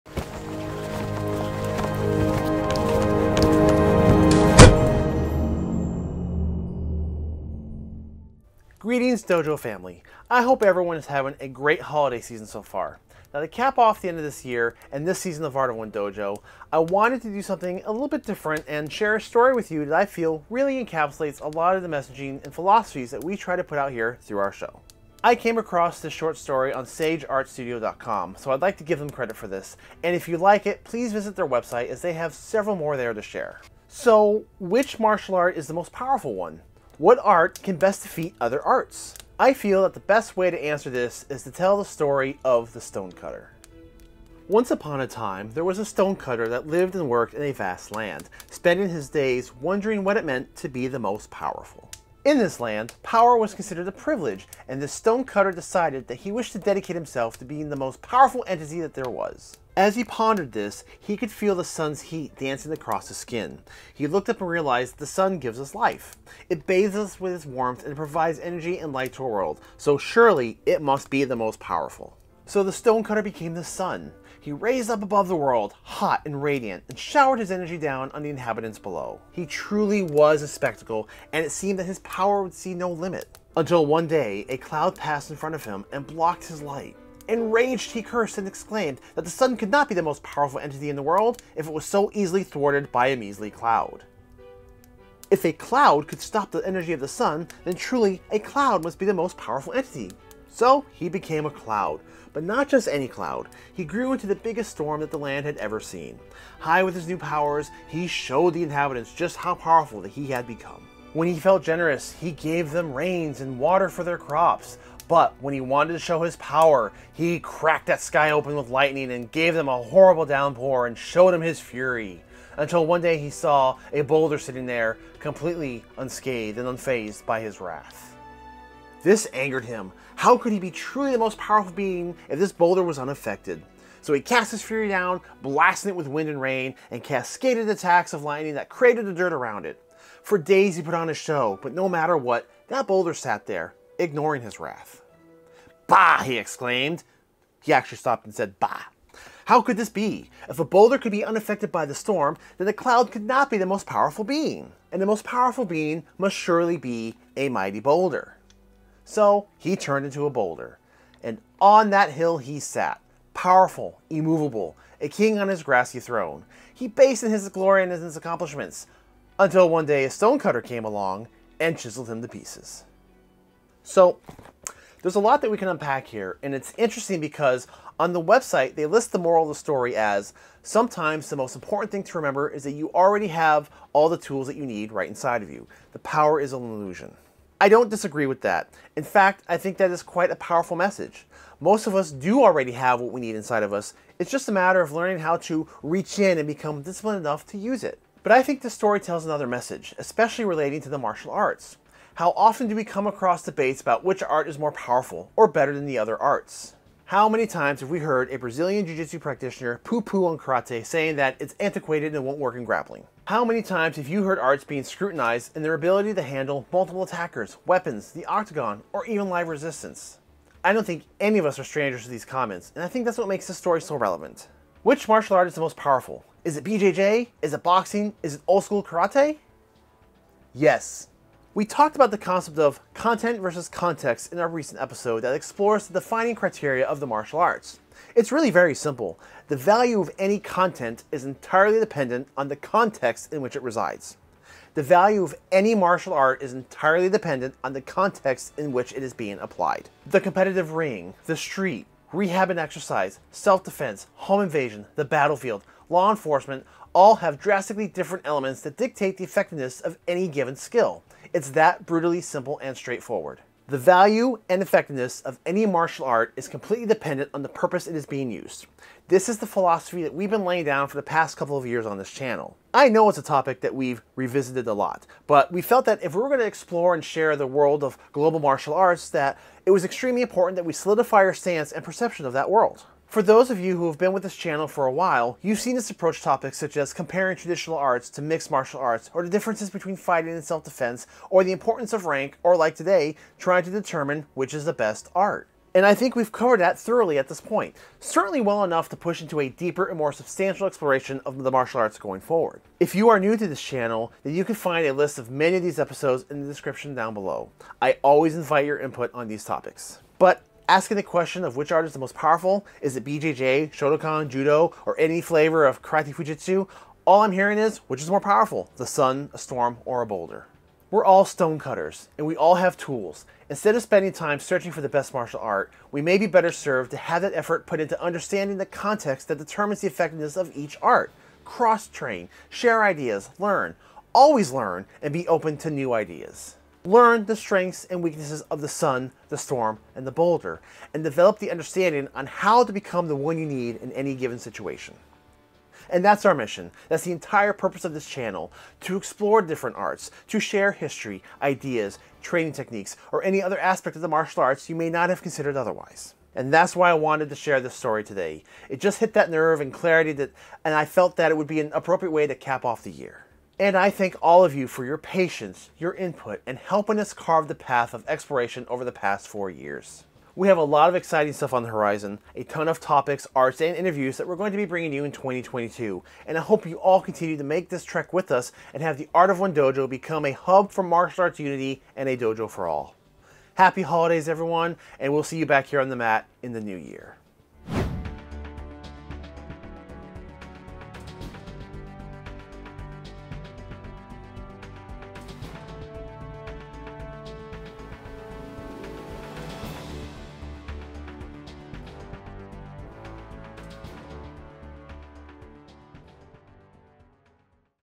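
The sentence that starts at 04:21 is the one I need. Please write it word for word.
It's that brutally simple and straightforward.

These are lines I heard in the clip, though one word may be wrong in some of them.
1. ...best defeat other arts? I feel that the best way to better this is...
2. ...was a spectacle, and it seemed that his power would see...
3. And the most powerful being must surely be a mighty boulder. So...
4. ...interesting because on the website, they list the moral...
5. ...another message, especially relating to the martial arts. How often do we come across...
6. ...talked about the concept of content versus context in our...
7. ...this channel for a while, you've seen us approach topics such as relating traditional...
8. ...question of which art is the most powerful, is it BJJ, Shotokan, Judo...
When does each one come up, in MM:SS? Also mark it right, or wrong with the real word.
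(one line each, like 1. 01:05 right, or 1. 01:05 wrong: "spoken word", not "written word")
1. 00:37 wrong: "answer", not "better"
2. 01:20 right
3. 02:34 right
4. 02:56 right
5. 03:19 right
6. 03:51 right
7. 04:44 wrong: "comparing", not "relating"
8. 05:11 right.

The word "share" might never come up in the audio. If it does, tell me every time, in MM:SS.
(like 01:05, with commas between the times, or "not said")
00:18, 00:33, 04:37, 05:32, 05:50, 05:57.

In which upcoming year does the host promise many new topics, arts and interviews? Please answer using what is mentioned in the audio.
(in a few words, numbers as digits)
2022.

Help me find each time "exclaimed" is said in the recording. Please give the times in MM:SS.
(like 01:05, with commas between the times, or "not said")
01:28, 02:26.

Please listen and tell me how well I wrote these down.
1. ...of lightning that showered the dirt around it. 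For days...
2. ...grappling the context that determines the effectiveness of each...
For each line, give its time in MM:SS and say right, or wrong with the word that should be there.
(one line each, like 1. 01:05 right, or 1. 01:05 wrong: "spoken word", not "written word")
1. 02:18 wrong: "created", not "showered"
2. 05:28 wrong: "understanding", not "grappling".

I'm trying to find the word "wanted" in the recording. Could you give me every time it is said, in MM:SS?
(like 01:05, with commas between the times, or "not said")
00:16, 01:55, 05:56.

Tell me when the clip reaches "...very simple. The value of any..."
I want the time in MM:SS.
03:58.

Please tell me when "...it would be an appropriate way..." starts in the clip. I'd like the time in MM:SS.
06:01.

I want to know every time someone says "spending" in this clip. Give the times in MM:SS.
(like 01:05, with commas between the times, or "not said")
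00:48, 05:23.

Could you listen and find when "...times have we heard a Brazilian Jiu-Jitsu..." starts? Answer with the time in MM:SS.
03:27.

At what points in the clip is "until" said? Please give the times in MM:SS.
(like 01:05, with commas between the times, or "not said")
01:23, 02:02, 02:49.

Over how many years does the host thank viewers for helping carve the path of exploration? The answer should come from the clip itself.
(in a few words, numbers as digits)
4.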